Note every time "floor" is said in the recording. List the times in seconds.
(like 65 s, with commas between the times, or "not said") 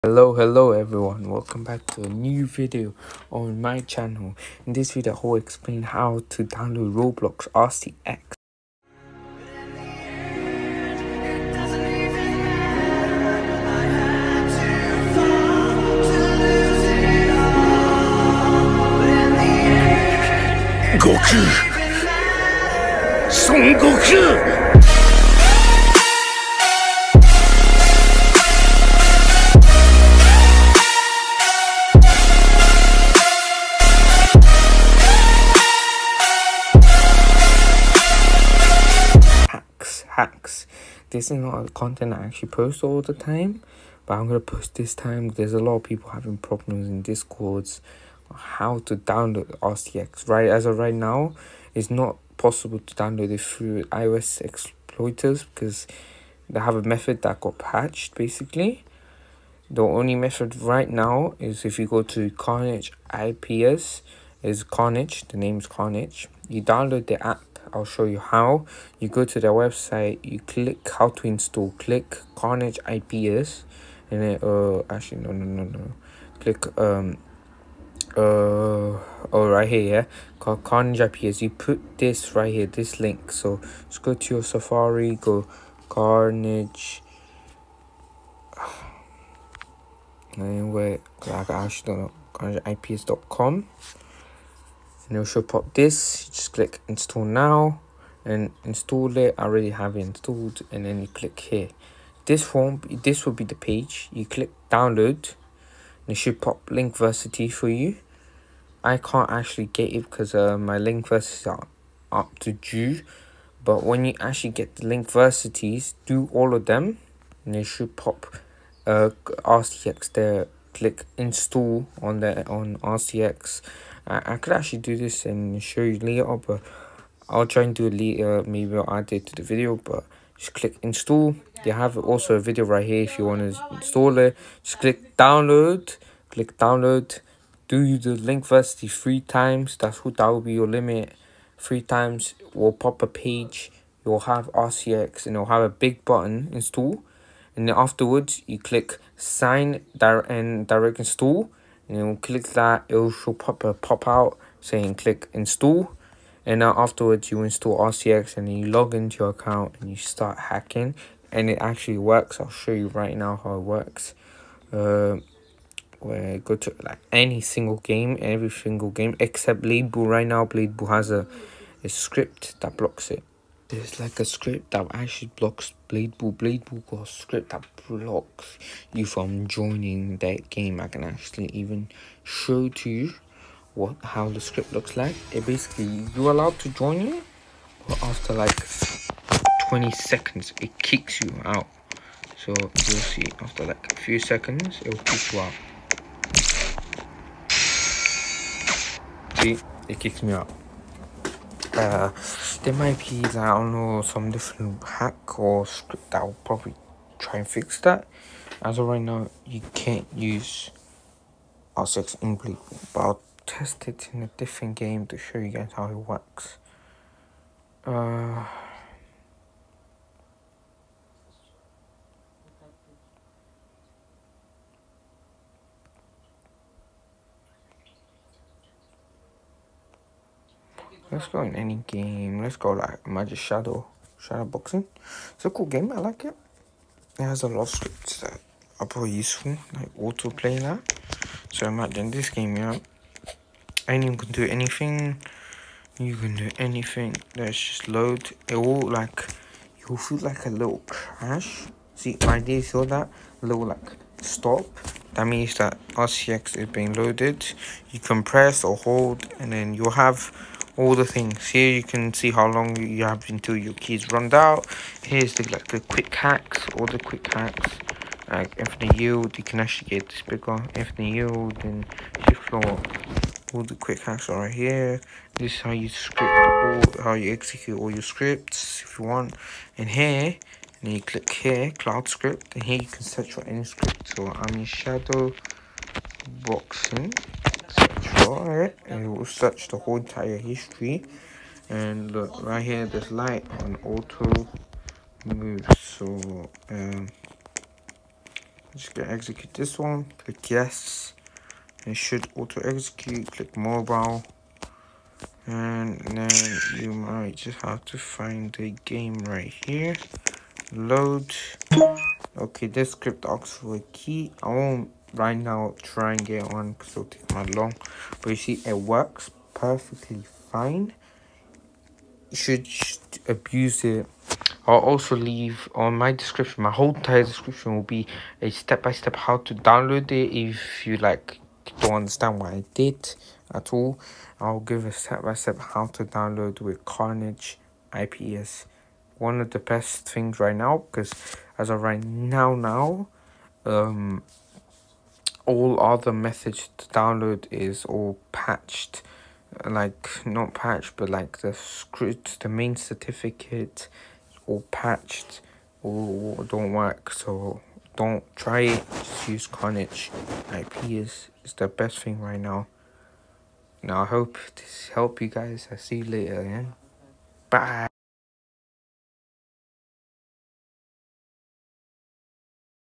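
272 s.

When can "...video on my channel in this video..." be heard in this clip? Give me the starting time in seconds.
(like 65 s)
2 s.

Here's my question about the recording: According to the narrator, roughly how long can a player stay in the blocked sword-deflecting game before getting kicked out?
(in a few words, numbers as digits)
20 seconds.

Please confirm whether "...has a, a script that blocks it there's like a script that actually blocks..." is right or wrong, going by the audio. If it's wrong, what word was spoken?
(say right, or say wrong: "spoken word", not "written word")
right.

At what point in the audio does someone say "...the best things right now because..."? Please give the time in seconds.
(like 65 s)
339 s.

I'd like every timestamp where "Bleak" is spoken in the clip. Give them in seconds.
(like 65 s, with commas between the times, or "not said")
212 s.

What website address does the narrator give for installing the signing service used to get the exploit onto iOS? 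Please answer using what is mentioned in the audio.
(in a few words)
carnageIPAS.com.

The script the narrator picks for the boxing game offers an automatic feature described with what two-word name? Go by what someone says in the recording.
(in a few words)
auto move.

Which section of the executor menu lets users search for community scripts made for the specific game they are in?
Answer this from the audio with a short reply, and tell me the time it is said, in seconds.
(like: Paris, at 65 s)
cloud script, at 281 s.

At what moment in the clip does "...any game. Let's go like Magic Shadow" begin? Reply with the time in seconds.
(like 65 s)
231 s.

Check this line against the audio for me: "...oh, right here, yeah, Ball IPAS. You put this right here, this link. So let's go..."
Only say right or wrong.
wrong.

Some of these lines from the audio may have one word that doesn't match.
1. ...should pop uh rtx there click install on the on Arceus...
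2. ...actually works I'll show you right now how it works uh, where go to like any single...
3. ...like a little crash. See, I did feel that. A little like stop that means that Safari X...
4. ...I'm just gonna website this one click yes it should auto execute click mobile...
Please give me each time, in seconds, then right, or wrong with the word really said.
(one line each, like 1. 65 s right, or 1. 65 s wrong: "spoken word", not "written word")
1. 117 s right
2. 161 s right
3. 250 s wrong: "Arceus", not "Safari"
4. 298 s wrong: "execute", not "website".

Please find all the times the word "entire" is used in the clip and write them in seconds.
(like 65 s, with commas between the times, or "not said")
289 s, 326 s.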